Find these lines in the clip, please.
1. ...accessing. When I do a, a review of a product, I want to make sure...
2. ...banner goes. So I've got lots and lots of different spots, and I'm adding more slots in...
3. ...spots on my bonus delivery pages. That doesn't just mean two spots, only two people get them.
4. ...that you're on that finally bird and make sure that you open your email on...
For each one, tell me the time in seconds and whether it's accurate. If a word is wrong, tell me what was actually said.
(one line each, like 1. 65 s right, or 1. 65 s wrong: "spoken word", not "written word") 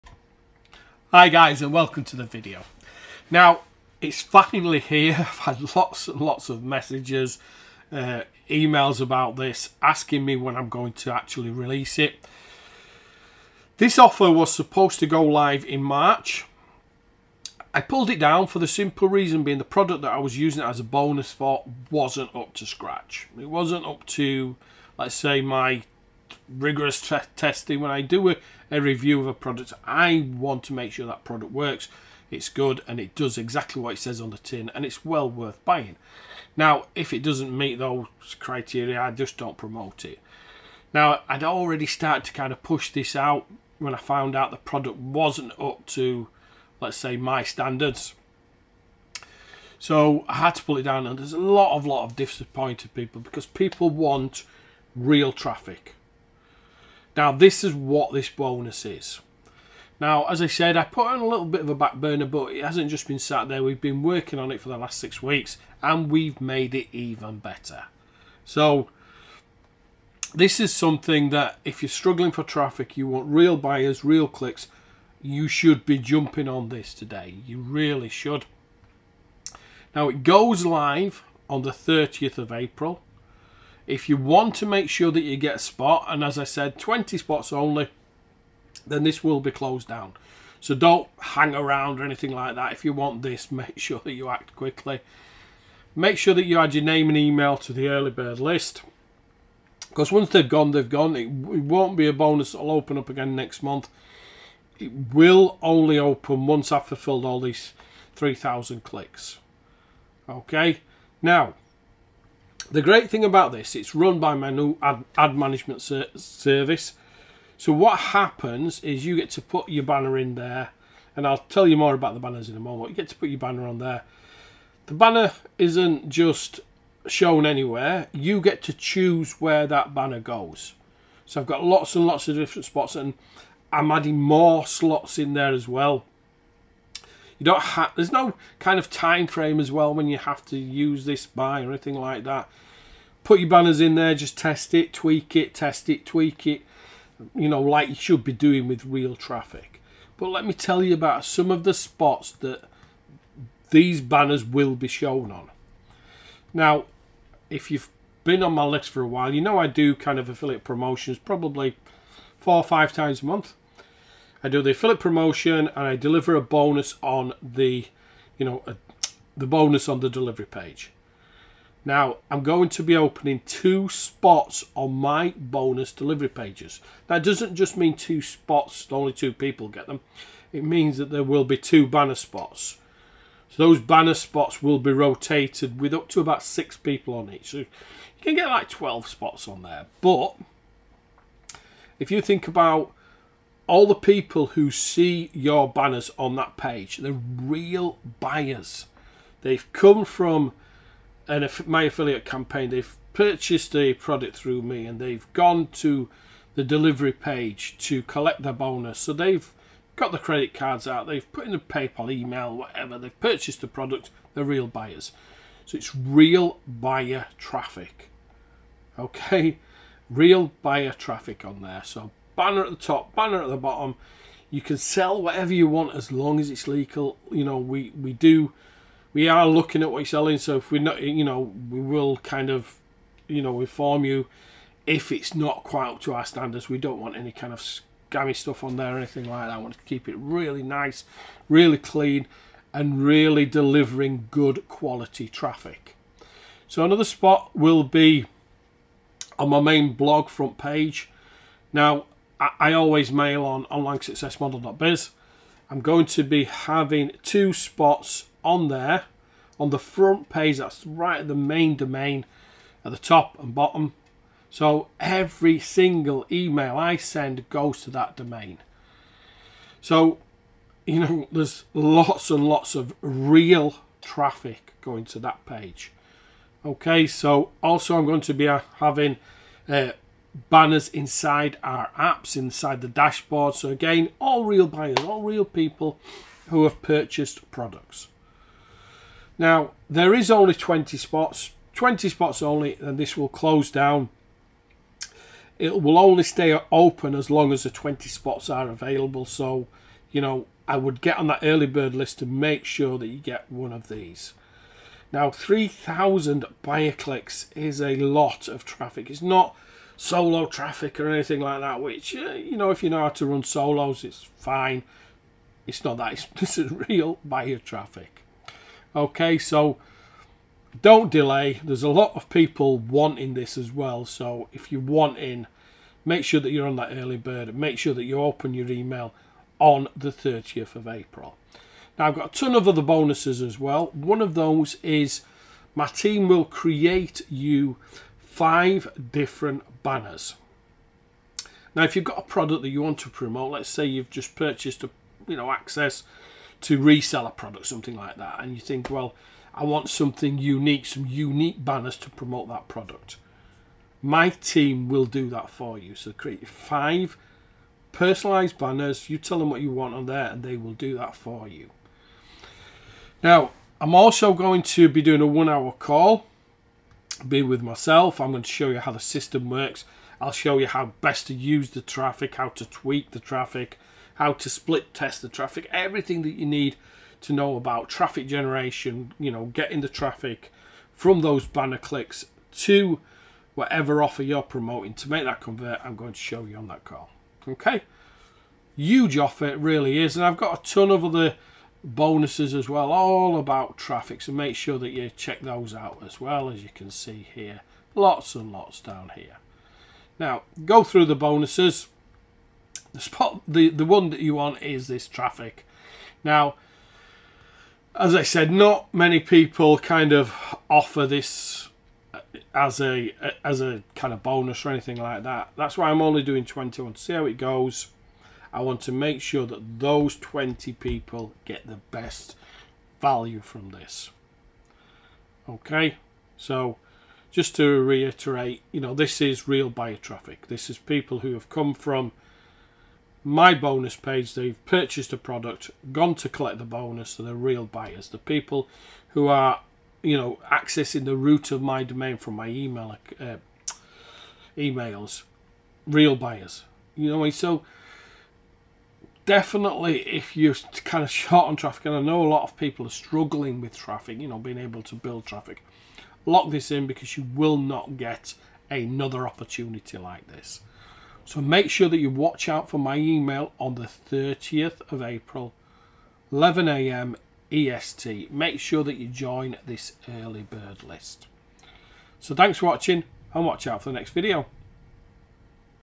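1. 27 s wrong: "testing", not "accessing"
2. 129 s right
3. 173 s right
4. 326 s wrong: "early", not "finally".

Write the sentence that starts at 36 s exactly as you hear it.
Now, if it doesn't meet those criteria, I just don't promote it.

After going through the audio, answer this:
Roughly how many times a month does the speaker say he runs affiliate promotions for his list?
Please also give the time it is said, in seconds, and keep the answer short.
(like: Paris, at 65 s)
four or five, at 162 s.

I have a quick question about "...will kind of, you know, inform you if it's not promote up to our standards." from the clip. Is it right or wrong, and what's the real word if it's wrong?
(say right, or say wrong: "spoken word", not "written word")
wrong: "quite", not "promote".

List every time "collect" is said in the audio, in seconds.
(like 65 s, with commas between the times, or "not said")
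208 s, 436 s.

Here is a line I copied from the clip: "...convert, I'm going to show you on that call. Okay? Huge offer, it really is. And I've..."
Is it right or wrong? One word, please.
right.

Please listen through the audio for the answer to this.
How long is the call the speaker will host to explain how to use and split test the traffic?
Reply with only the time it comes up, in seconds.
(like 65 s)
365 s.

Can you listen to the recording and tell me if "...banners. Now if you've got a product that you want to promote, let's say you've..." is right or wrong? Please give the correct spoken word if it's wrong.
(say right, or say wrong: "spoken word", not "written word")
right.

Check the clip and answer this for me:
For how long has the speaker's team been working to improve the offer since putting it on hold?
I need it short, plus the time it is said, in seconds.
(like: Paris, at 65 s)
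six weeks, at 64 s.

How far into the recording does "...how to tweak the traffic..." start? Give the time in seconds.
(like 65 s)
372 s.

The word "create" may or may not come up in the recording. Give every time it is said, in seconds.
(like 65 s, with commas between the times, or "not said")
336 s, 356 s.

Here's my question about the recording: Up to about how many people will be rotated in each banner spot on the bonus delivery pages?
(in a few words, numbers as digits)
6.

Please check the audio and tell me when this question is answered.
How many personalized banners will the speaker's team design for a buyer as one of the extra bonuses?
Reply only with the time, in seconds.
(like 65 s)
356 s.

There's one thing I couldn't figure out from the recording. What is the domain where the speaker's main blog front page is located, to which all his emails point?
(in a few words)
onlinesuccessmodel.biz.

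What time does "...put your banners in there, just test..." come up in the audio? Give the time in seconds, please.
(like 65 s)
143 s.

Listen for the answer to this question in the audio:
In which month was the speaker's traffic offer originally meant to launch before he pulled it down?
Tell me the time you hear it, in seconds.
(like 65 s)
15 s.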